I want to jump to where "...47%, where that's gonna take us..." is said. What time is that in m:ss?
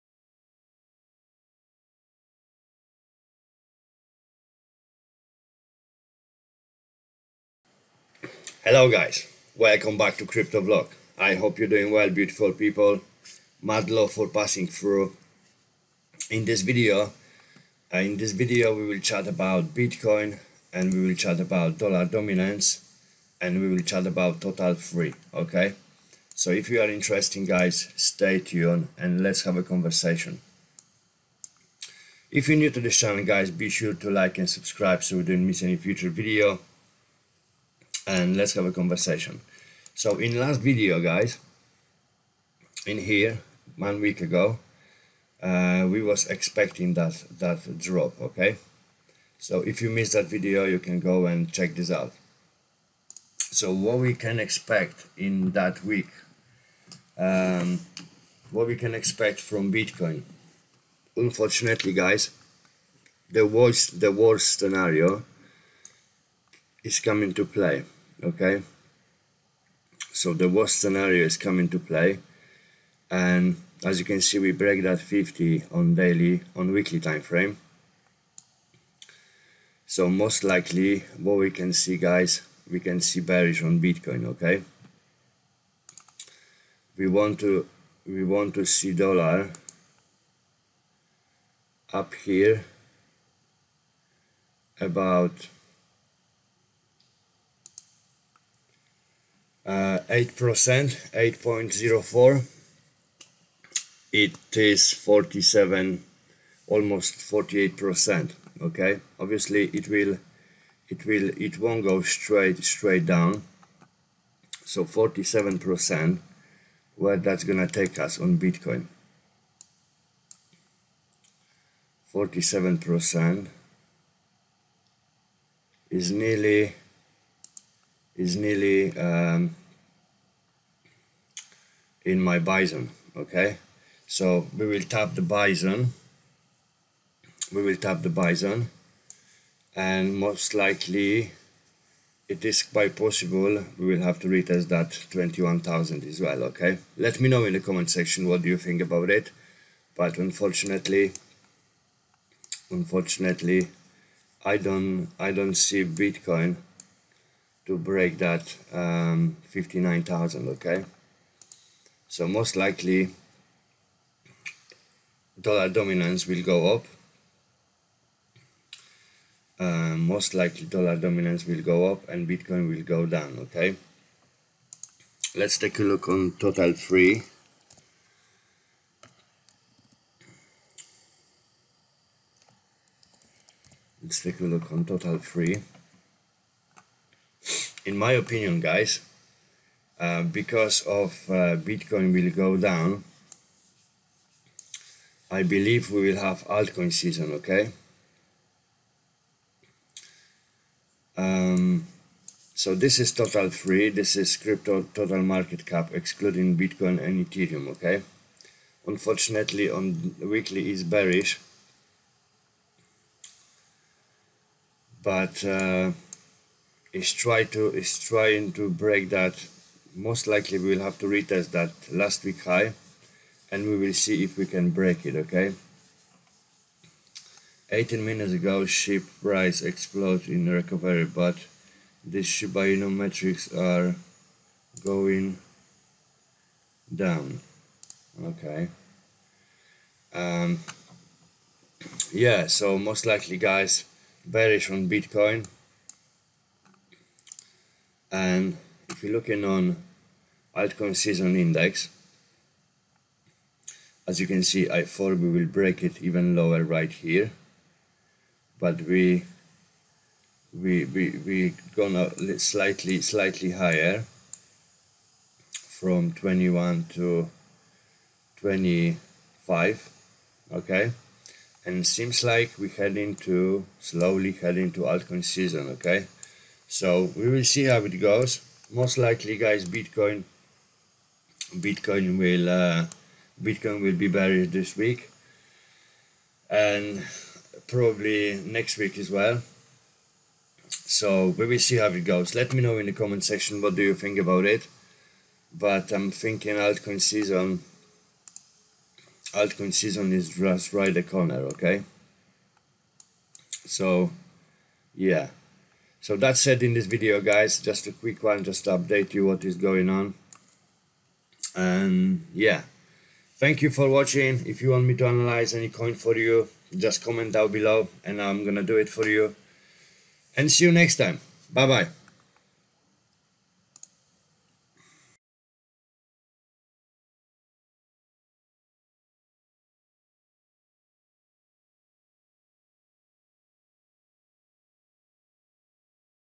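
1:54.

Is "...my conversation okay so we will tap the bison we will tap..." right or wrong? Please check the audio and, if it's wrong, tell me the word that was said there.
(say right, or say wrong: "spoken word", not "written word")
wrong: "bison", not "conversation".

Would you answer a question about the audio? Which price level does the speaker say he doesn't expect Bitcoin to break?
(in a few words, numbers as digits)
59,000.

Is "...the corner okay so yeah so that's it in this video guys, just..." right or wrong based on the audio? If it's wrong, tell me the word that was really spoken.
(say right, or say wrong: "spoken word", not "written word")
right.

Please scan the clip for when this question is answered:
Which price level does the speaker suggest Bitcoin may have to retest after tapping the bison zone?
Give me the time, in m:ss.
2:25.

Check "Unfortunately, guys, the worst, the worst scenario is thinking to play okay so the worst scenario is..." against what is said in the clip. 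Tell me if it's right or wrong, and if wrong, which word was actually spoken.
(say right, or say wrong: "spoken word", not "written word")
wrong: "coming", not "thinking".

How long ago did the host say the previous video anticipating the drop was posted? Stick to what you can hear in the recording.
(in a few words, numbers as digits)
one week ago.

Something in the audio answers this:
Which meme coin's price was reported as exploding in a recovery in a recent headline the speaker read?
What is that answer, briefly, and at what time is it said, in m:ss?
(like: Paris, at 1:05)
SHIB, at 3:48.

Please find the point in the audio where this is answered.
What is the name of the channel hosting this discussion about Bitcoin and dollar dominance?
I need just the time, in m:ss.
0:10.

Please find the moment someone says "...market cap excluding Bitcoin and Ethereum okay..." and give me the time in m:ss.
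3:25.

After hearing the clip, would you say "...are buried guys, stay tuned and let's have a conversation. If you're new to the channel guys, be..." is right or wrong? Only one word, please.
wrong.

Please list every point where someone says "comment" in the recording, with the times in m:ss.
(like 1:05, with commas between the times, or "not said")
2:27, 4:52, 5:17.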